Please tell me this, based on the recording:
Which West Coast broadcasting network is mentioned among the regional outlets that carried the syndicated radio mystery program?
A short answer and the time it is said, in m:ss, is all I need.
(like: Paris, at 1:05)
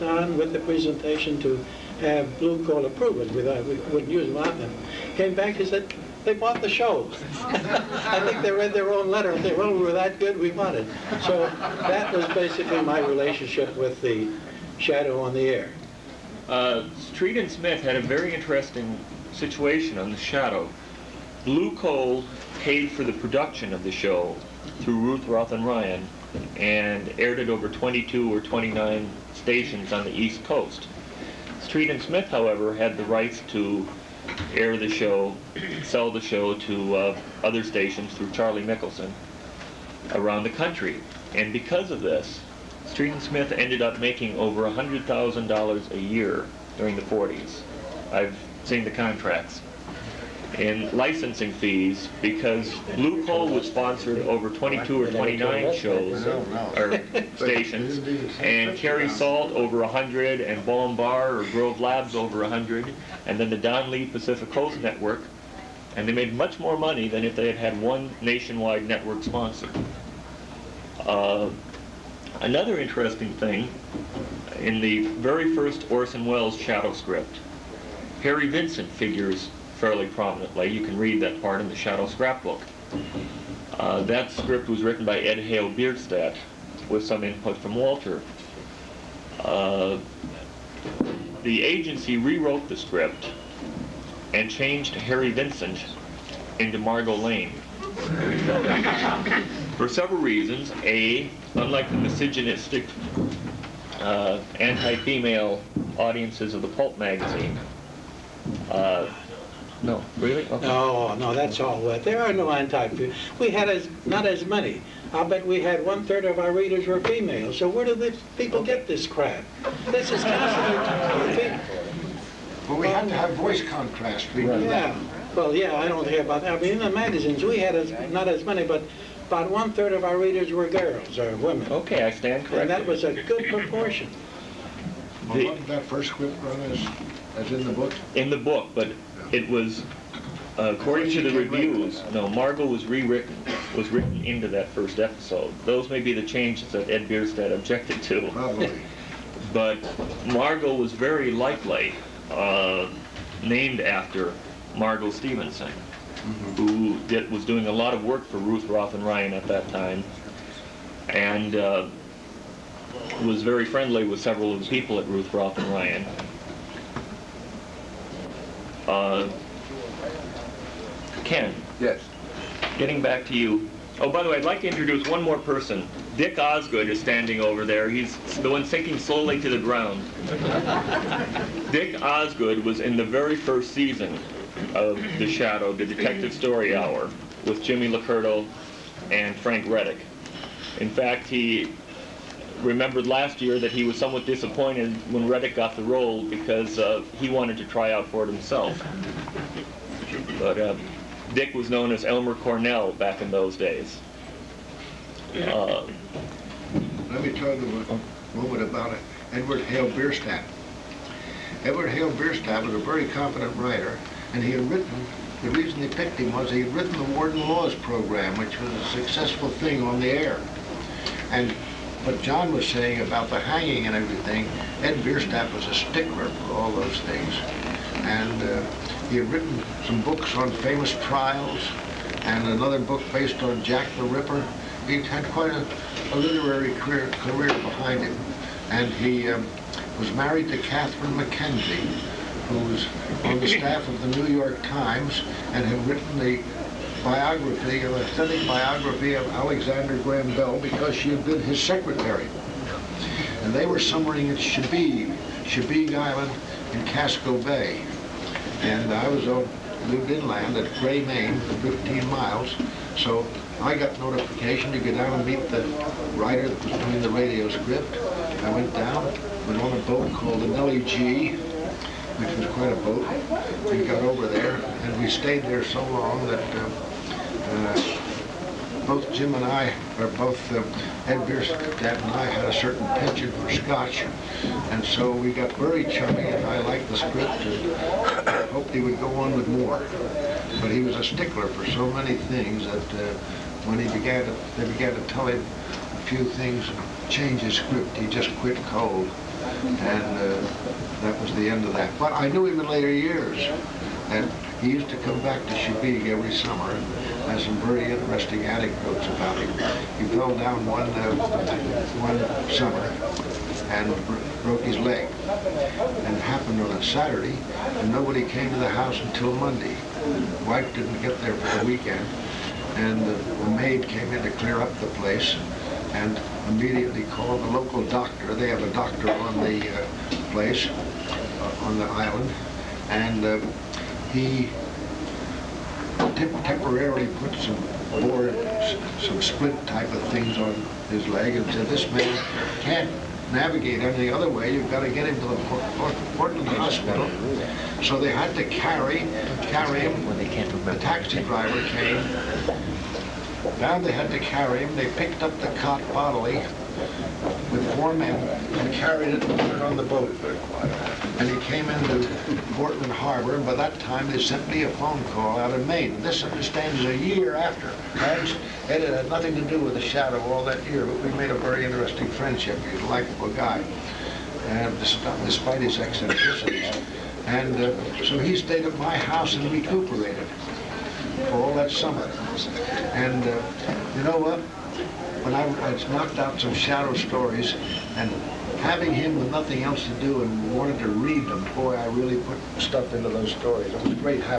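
Don Lee Pacific Coast Network, at 1:03.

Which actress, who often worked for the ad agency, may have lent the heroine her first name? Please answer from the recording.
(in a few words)
Margot Stevenson.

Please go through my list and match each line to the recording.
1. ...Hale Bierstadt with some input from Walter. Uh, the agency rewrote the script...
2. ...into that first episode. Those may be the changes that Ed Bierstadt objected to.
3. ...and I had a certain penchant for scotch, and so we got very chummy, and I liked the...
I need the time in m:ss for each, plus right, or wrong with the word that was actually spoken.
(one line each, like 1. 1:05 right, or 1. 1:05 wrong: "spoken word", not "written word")
1. 1:25 right
2. 2:24 right
3. 4:42 right.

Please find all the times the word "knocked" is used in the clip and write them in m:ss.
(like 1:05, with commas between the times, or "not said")
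6:25.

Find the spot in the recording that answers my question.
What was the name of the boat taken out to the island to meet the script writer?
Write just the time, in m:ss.
4:30.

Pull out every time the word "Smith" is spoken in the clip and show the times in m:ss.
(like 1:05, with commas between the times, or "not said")
0:17, 0:32, 0:43.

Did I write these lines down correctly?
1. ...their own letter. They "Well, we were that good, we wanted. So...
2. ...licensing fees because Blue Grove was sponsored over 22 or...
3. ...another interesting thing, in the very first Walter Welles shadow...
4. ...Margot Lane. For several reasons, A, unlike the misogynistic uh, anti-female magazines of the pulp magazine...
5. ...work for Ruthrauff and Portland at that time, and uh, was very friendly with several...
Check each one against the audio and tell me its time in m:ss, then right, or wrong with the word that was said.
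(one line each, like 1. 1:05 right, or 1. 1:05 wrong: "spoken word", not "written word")
1. 0:08 right
2. 0:50 wrong: "Coal", not "Grove"
3. 1:12 wrong: "Orson", not "Walter"
4. 1:36 wrong: "audiences", not "magazines"
5. 2:38 wrong: "Ryan", not "Portland".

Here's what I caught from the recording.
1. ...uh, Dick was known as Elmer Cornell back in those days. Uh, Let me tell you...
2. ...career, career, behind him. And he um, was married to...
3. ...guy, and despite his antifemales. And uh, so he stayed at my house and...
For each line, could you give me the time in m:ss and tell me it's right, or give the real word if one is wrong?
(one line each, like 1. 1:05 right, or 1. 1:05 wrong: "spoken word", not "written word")
1. 3:20 right
2. 3:56 right
3. 6:13 wrong: "eccentricities", not "antifemales".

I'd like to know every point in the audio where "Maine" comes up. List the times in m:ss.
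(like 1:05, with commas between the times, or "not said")
4:21, 6:05.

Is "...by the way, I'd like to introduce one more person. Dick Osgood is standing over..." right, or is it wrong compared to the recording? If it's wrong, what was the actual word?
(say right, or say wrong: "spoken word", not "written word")
right.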